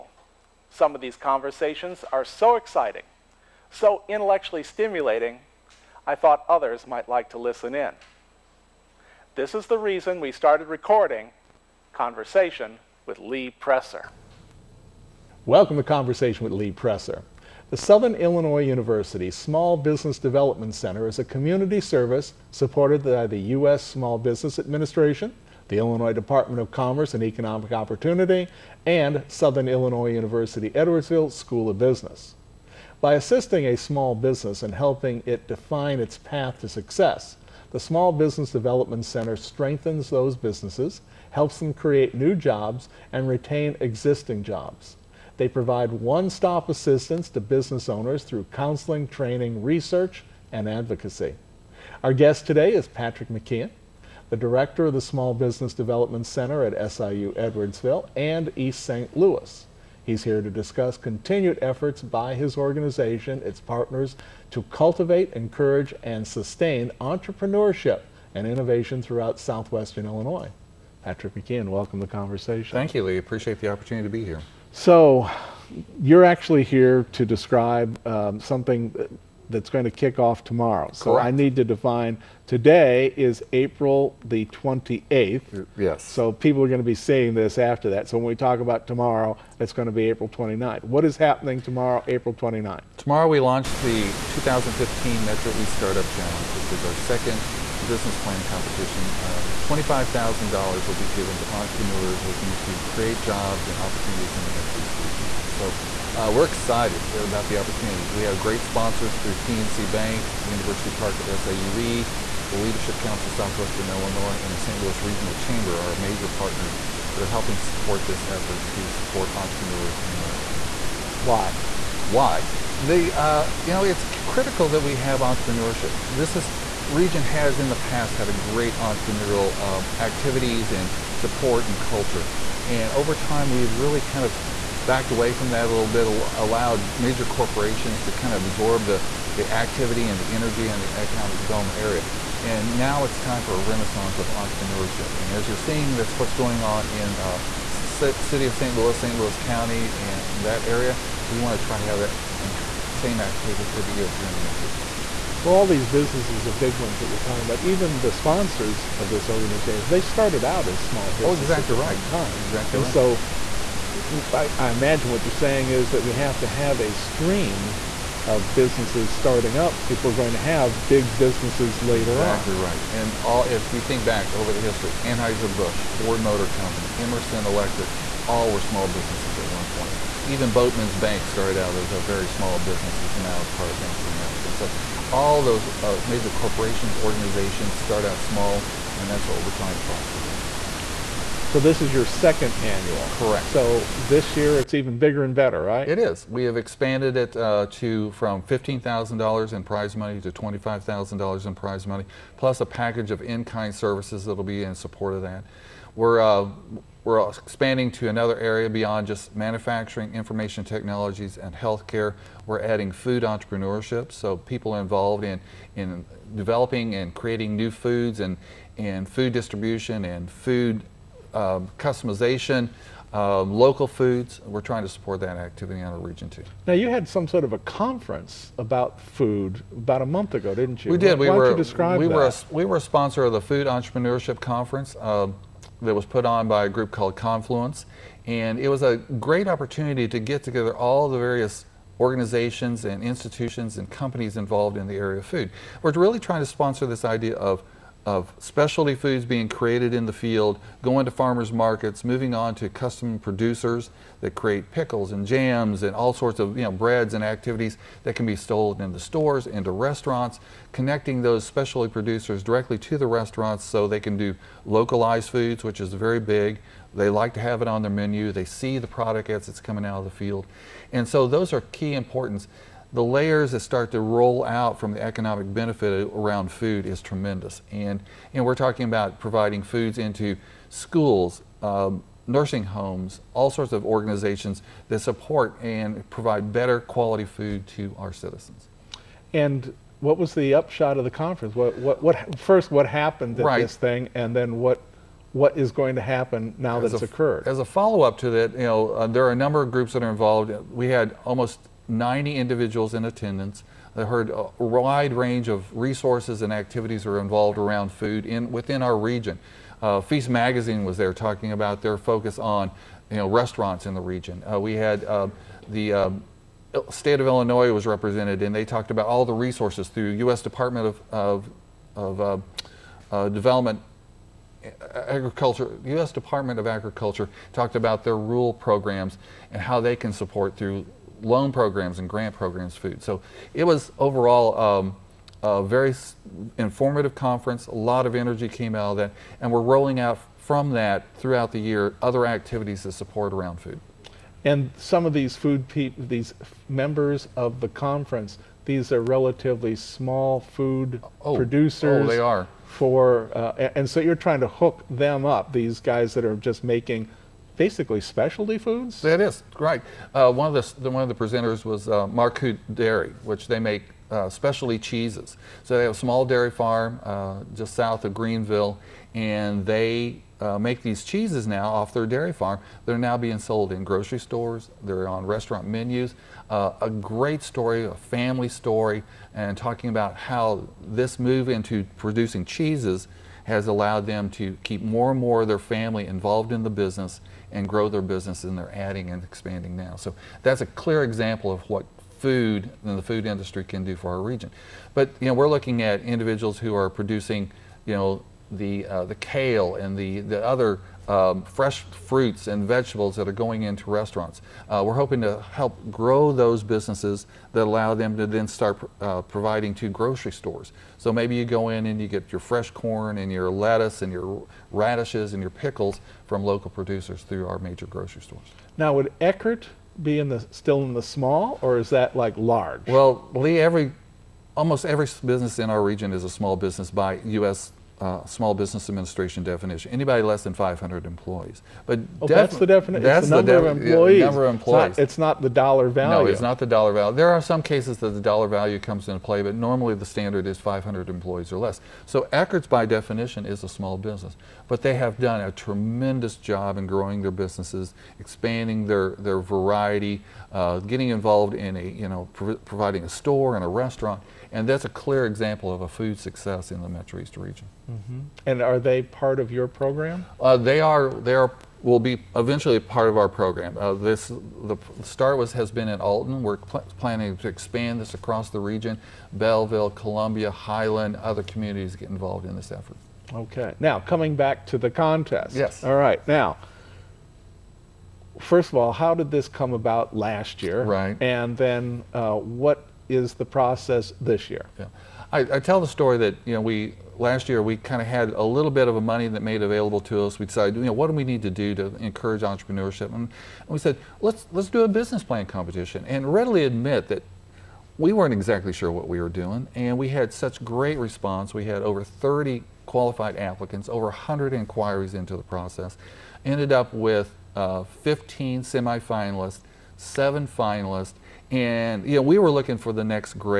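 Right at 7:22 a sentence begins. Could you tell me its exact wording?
So Eckert's, by definition, is a small business.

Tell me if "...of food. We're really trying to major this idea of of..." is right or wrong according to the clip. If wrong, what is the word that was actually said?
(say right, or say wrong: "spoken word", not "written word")
wrong: "sponsor", not "major".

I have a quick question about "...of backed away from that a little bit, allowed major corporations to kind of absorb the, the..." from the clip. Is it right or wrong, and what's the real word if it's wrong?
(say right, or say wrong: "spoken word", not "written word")
right.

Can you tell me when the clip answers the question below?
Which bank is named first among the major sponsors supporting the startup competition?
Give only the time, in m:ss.
1:49.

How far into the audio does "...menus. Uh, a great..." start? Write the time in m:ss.
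6:15.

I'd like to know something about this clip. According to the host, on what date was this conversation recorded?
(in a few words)
April 28th.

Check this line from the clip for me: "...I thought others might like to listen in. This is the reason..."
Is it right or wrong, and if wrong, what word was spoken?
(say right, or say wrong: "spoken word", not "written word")
right.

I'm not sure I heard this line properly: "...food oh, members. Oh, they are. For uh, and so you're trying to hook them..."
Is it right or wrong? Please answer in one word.
wrong.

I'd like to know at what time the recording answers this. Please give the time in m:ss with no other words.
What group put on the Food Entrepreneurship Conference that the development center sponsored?
3:57.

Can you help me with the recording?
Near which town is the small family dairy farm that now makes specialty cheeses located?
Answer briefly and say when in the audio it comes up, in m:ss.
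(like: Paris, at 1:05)
Greenville, at 6:08.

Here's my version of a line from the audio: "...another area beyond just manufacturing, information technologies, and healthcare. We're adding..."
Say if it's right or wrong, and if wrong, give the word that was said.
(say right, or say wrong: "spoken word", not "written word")
right.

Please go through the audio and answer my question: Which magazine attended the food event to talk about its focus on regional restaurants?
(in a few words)
Feast Magazine.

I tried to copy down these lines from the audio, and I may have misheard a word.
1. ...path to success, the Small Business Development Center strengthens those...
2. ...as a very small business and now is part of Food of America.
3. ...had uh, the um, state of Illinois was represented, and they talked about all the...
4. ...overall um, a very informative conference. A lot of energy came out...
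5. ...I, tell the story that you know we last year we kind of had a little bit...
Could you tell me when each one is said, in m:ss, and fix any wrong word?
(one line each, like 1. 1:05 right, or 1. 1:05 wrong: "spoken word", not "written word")
1. 0:36 right
2. 3:01 wrong: "Bank", not "Food"
3. 5:14 right
4. 5:33 right
5. 8:05 right.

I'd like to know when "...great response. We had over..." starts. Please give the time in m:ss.
8:20.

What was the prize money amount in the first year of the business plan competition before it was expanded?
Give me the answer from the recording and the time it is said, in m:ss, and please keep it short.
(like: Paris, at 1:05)
$15,000, at 3:18.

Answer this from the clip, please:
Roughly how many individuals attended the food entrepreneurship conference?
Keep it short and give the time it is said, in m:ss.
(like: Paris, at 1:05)
90, at 5:01.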